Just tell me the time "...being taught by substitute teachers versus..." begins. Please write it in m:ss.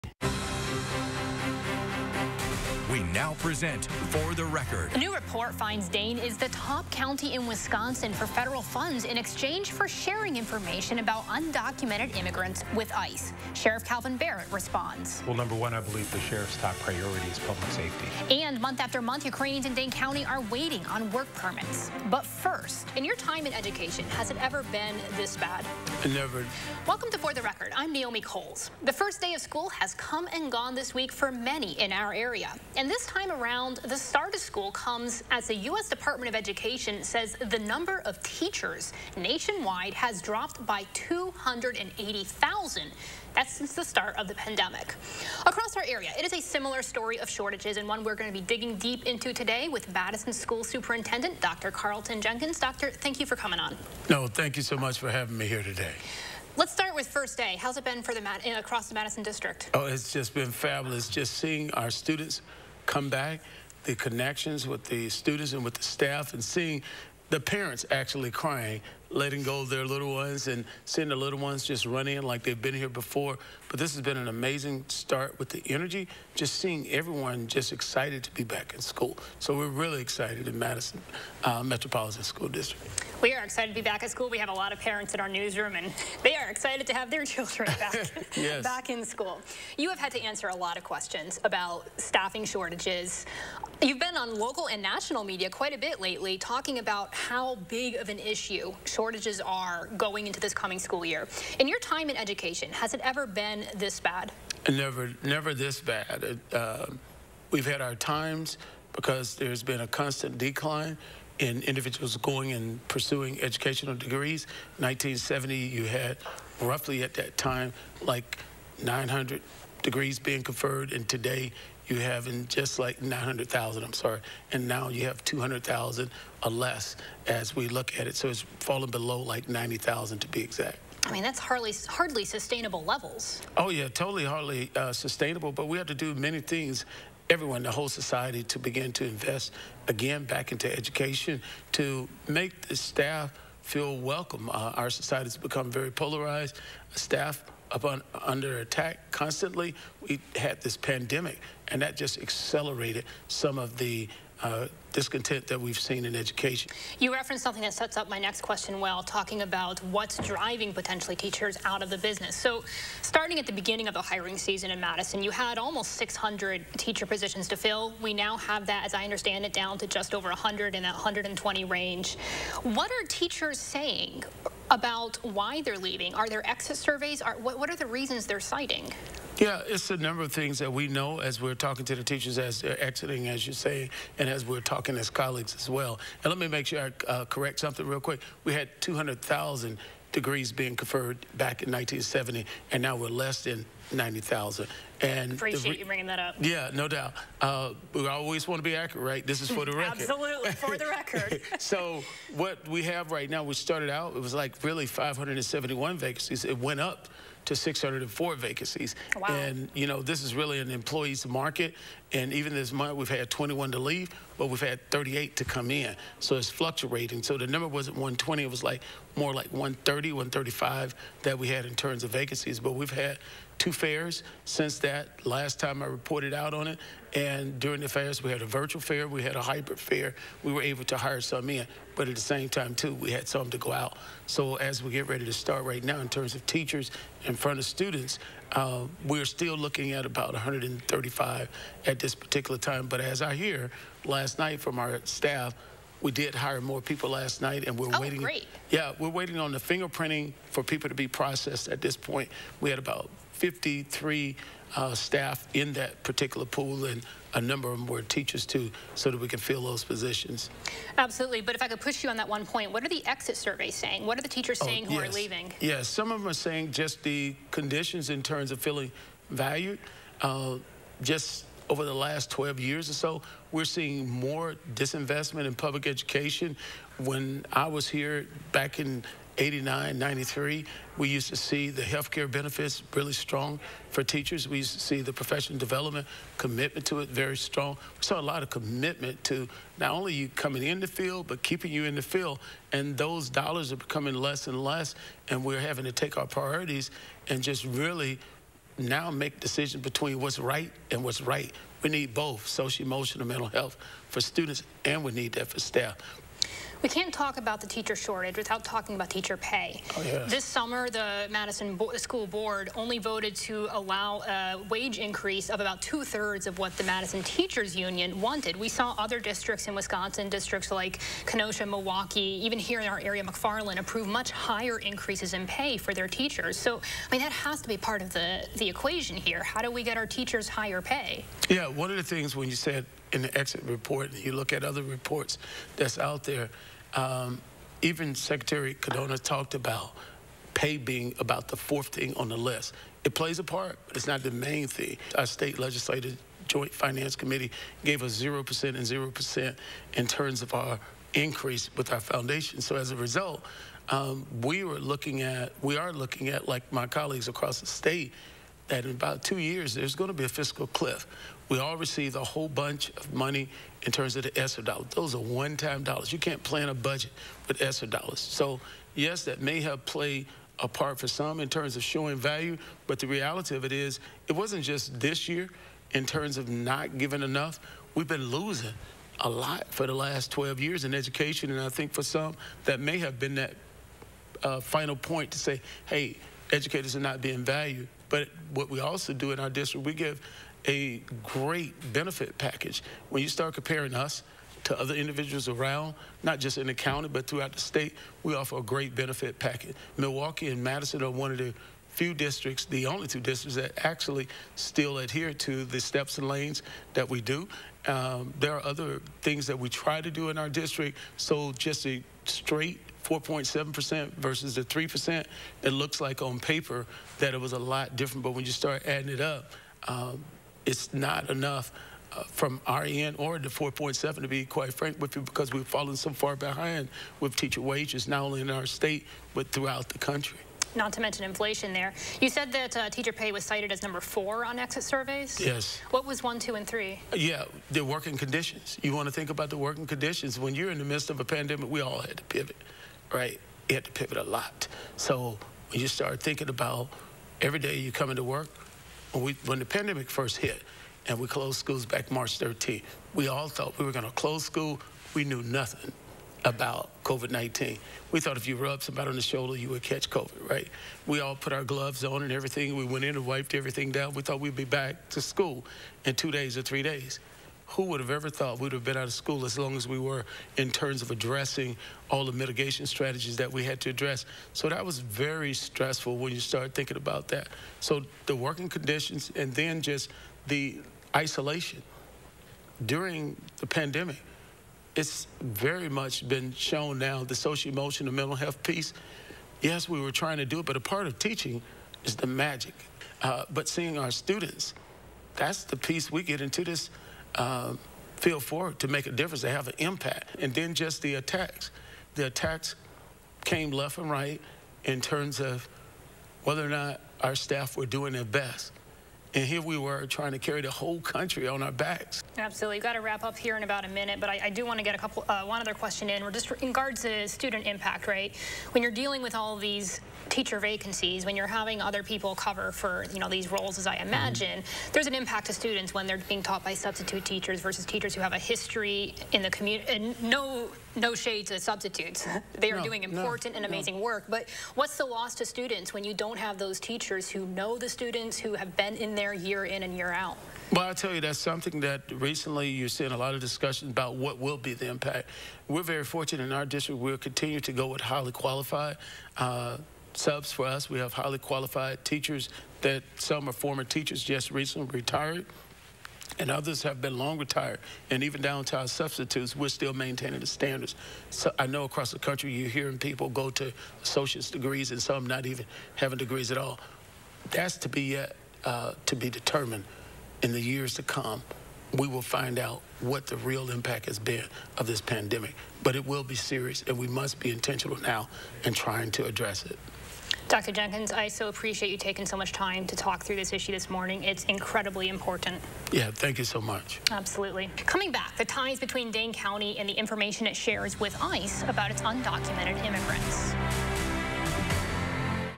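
8:46.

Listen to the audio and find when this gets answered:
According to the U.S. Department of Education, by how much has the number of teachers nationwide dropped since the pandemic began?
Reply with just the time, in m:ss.
0:40.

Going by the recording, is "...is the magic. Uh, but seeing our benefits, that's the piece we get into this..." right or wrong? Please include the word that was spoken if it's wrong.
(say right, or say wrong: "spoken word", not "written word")
wrong: "students", not "benefits".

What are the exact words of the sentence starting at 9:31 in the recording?
We will find out what the real impact has been of this pandemic.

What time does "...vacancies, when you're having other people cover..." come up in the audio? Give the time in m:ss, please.
8:40.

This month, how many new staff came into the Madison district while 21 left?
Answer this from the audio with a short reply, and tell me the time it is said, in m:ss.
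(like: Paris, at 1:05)
38, at 3:34.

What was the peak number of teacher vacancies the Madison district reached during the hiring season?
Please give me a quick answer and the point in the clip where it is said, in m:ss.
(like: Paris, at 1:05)
604, at 3:27.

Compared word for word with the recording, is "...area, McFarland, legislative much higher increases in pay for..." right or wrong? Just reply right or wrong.
wrong.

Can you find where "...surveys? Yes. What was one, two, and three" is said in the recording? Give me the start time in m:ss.
7:14.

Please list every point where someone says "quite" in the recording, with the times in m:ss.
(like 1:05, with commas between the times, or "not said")
1:35, 7:04.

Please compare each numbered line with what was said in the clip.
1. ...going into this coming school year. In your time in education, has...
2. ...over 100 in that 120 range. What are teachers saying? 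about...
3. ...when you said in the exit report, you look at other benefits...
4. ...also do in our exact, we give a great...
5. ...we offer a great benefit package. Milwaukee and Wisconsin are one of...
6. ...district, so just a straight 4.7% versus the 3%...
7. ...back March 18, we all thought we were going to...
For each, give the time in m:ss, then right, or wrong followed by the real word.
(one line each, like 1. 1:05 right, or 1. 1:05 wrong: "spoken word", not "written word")
1. 1:39 right
2. 2:50 right
3. 5:32 wrong: "reports", not "benefits"
4. 6:28 wrong: "district", not "exact"
5. 6:38 wrong: "Madison", not "Wisconsin"
6. 6:50 right
7. 7:31 wrong: "13", not "18".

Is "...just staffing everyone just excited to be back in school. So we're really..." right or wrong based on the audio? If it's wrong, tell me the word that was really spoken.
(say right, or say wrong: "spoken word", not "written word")
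wrong: "seeing", not "staffing".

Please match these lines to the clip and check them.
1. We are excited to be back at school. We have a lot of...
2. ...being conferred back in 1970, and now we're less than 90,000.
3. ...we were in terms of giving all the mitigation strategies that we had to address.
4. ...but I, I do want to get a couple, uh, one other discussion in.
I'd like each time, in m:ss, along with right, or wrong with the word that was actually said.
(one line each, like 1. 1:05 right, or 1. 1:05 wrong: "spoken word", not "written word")
1. 1:23 right
2. 3:10 right
3. 7:49 wrong: "addressing", not "giving"
4. 8:34 wrong: "question", not "discussion".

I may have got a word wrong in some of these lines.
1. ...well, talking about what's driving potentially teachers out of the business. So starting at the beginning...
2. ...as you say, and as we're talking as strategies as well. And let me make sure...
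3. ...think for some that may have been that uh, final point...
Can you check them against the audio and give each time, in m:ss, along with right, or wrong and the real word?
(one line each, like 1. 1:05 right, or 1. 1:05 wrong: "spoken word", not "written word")
1. 2:38 right
2. 3:03 wrong: "colleagues", not "strategies"
3. 6:21 right.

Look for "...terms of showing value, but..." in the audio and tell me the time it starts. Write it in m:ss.
6:11.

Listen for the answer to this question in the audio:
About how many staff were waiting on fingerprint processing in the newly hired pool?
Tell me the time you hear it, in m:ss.
4:13.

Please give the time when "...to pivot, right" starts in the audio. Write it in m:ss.
7:22.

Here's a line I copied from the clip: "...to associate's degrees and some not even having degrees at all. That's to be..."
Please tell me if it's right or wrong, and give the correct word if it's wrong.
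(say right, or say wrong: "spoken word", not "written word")
right.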